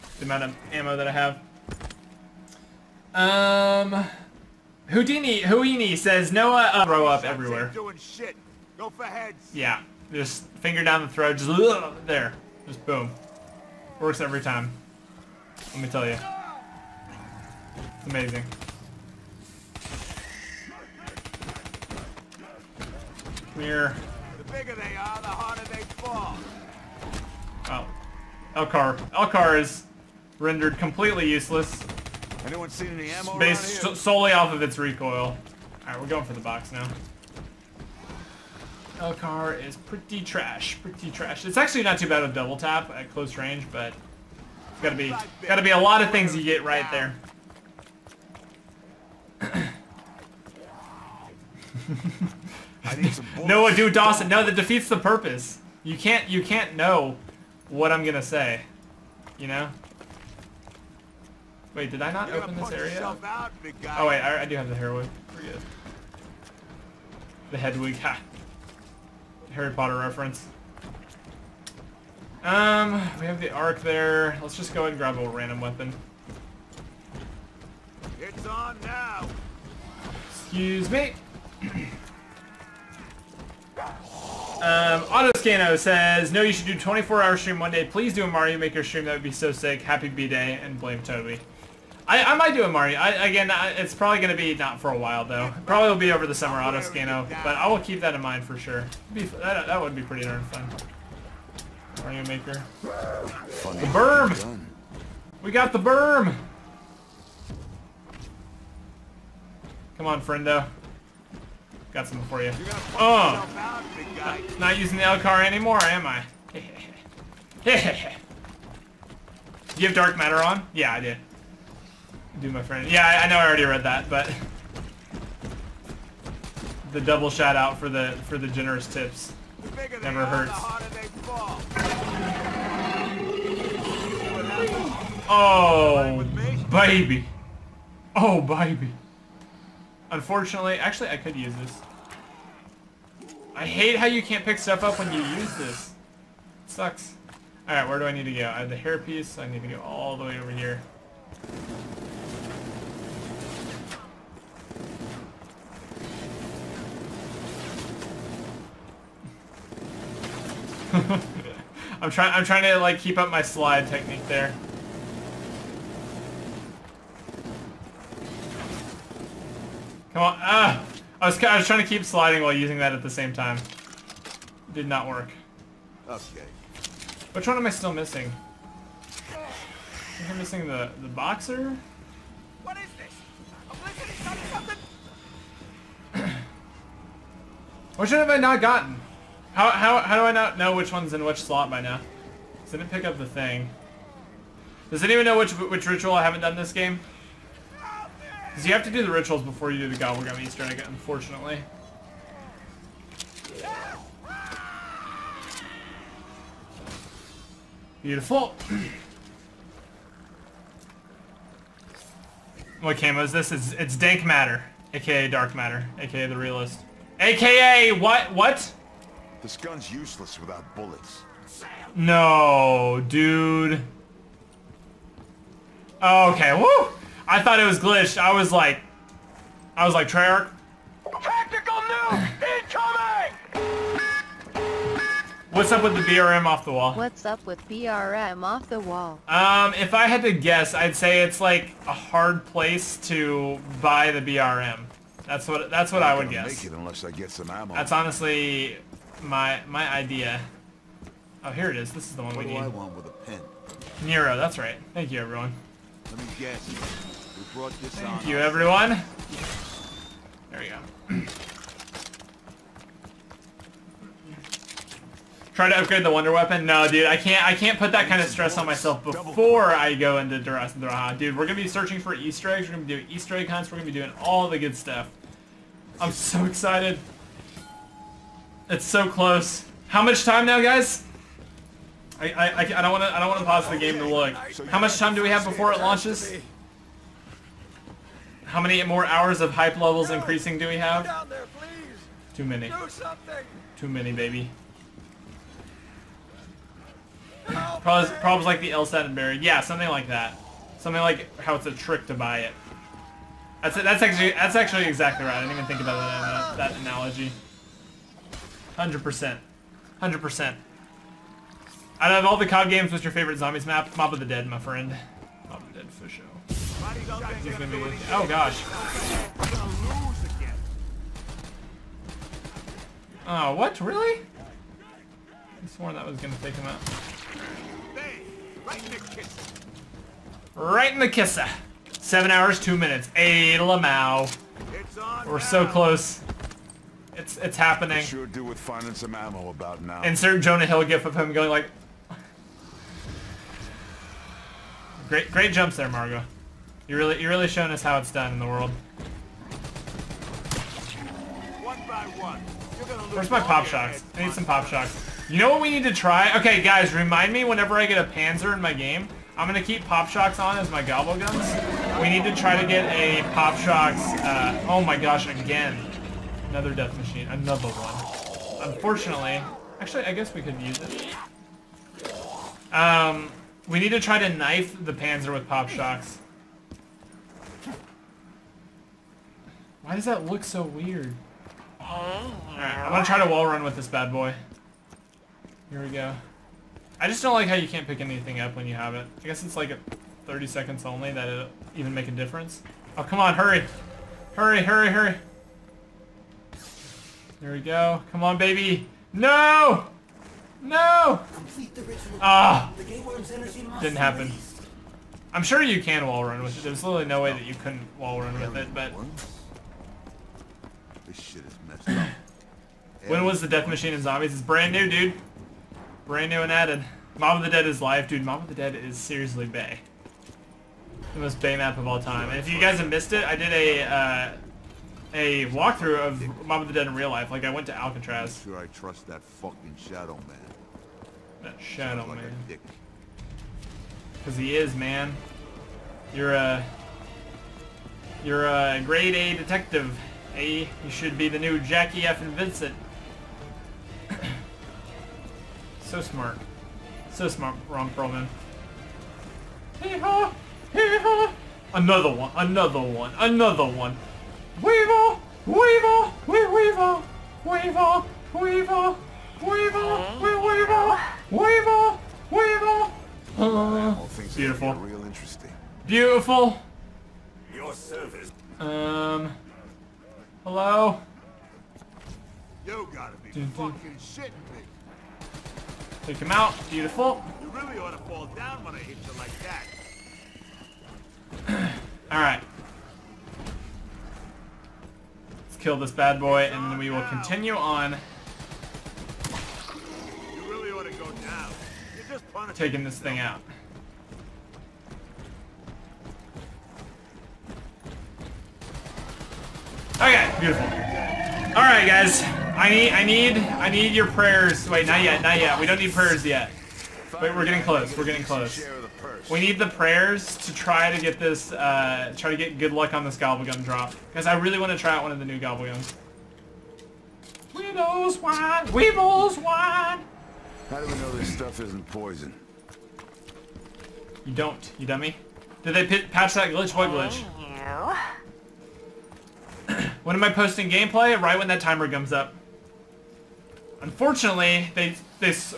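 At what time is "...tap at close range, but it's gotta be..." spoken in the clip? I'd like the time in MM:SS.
00:42.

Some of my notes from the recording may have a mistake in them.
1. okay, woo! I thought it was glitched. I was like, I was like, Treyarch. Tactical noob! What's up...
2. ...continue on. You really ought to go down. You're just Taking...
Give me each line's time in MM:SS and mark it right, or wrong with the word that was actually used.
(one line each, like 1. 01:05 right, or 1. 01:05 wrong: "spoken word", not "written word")
1. 03:46 right
2. 08:07 right.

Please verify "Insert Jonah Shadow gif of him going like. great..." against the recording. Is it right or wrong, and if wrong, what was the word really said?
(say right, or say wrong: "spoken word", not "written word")
wrong: "Hill", not "Shadow".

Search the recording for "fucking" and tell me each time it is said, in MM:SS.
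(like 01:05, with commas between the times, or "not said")
07:09, 07:53.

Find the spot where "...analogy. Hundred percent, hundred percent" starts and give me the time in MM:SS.
05:06.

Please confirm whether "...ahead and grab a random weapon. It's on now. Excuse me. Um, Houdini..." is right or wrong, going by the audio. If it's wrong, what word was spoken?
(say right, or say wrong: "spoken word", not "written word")
wrong: "Autoscano", not "Houdini".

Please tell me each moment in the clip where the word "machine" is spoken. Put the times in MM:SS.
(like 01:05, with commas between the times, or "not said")
06:06, 06:53.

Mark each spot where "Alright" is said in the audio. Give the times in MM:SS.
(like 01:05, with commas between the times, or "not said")
00:35, 02:27, 06:21, 08:02.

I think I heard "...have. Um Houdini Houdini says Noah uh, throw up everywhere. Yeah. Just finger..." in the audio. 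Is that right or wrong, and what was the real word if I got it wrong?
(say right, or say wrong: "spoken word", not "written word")
right.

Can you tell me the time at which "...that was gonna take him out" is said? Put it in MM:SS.
05:25.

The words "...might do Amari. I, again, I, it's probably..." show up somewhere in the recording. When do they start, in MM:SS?
01:32.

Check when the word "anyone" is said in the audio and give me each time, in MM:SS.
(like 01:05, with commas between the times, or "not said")
00:32, 03:15.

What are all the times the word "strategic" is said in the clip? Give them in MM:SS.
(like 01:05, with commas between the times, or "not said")
not said.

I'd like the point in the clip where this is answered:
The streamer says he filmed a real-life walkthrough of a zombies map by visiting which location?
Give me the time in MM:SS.
07:07.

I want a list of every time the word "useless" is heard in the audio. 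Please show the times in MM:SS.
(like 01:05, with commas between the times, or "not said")
00:31, 03:39.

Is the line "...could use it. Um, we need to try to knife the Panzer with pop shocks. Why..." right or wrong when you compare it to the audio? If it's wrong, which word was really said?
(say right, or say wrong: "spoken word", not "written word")
right.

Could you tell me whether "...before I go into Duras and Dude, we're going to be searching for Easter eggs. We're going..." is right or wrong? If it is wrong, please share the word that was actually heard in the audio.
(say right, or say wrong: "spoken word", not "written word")
right.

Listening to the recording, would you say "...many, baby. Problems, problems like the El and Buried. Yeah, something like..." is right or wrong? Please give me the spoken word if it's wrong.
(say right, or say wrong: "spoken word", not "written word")
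right.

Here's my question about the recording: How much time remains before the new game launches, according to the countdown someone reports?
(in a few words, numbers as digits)
7 hours, 2 minutes.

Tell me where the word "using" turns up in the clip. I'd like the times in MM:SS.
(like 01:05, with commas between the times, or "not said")
01:54, 02:52.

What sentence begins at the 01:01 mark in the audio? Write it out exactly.
Wait, did I not open this area?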